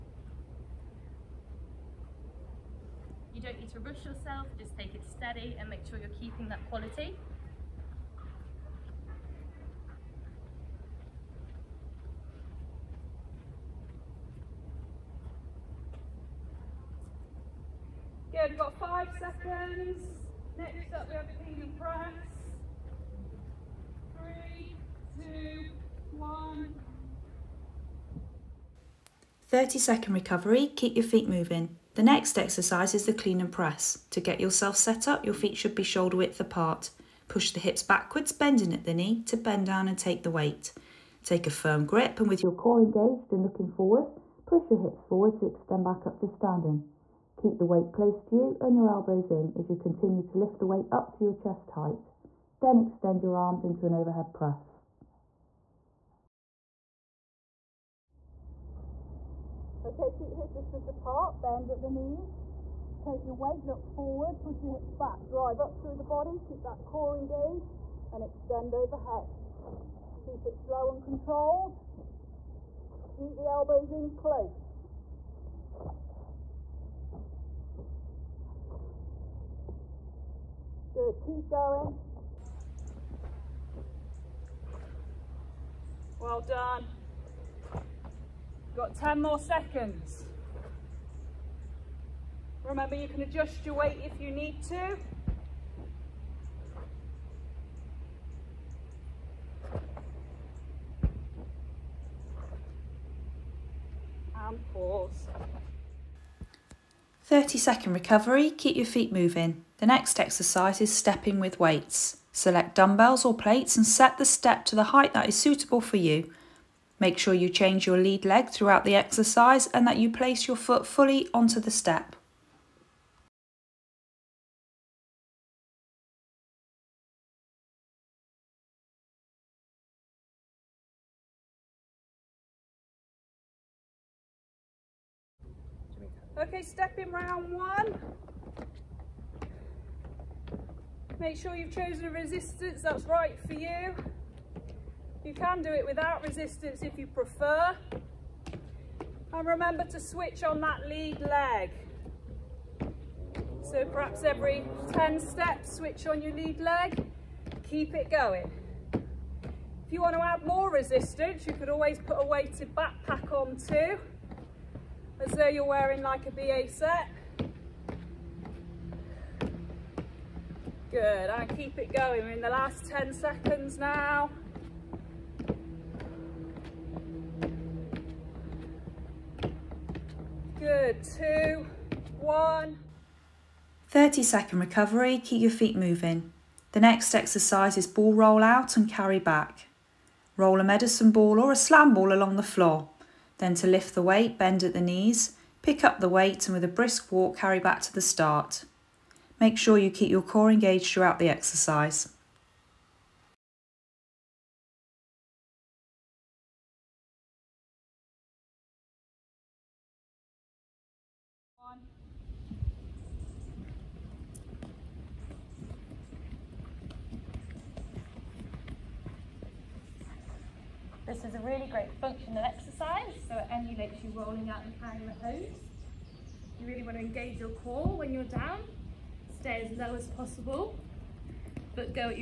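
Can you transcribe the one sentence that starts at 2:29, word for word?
And remember to switch on that lead leg.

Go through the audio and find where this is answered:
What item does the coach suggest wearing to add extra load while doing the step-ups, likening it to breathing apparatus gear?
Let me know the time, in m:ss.
2:42.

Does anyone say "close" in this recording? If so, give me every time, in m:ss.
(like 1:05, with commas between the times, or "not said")
0:47, 1:14.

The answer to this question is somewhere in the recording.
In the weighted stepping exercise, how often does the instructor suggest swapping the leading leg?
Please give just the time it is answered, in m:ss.
2:34.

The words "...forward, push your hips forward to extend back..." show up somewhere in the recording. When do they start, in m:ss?
0:43.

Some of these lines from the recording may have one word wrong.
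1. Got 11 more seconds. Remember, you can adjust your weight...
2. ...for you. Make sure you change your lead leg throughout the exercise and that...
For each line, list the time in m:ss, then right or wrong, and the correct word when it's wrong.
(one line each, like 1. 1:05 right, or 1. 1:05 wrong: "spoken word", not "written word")
1. 1:28 wrong: "10", not "11"
2. 1:55 right.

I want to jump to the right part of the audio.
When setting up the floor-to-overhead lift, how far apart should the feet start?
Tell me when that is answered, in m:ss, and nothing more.
0:35.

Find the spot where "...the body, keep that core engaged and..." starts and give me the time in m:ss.
1:05.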